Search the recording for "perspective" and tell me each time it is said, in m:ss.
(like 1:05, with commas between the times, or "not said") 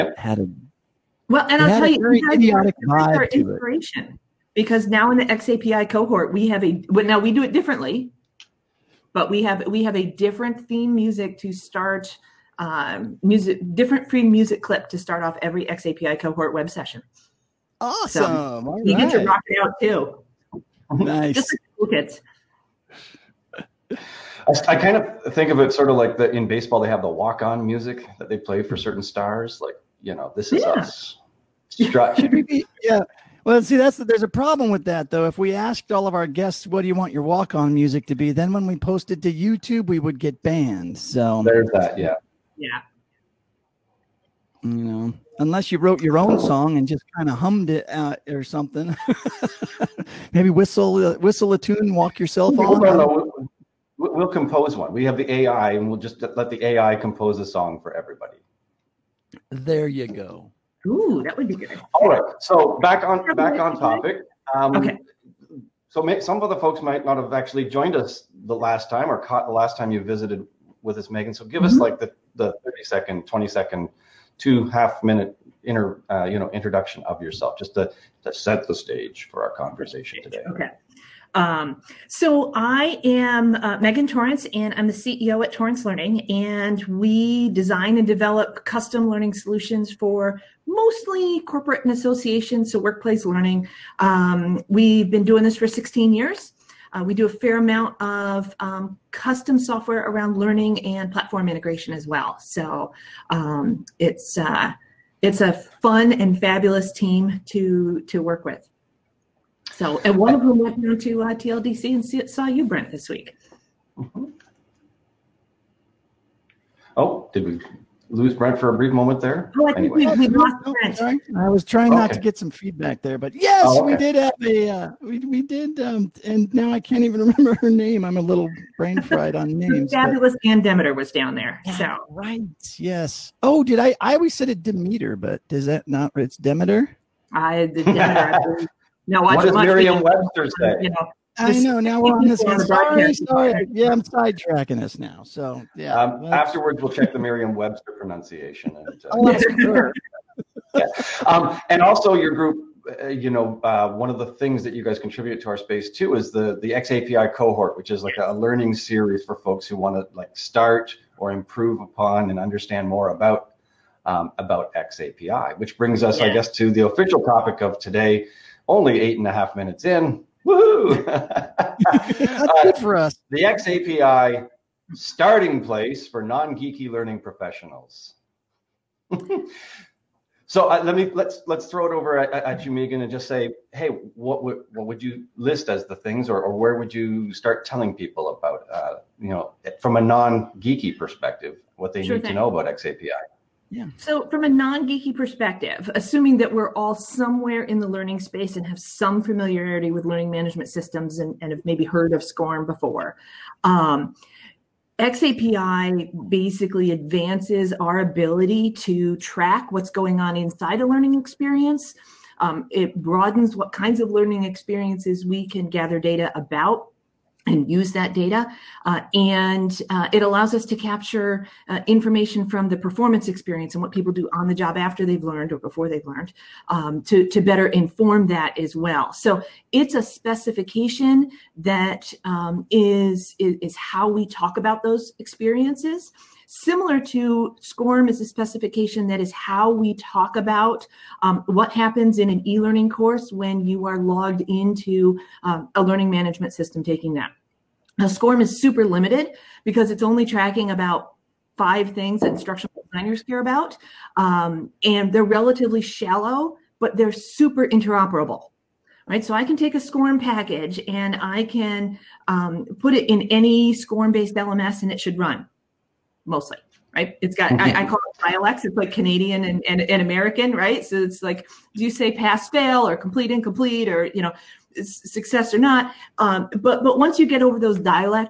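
3:10, 3:15.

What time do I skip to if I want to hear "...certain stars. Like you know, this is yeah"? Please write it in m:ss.
0:28.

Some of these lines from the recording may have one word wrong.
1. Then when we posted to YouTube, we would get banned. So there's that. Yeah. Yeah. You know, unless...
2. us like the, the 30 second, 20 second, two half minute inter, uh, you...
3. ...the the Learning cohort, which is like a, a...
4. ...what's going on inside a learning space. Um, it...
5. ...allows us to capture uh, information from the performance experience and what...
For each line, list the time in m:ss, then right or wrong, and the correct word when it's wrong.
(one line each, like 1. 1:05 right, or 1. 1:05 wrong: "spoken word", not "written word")
1. 0:38 right
2. 1:11 right
3. 2:36 wrong: "XAPI", not "Learning"
4. 3:29 wrong: "experience", not "space"
5. 3:40 right.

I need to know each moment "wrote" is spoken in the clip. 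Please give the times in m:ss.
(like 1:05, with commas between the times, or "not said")
0:45.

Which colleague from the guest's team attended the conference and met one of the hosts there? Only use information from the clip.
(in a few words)
Ann Demeter.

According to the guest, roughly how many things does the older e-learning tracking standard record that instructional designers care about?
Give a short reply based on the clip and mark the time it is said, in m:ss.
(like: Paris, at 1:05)
5, at 4:11.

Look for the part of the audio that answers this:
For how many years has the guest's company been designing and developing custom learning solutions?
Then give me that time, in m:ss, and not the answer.
1:35.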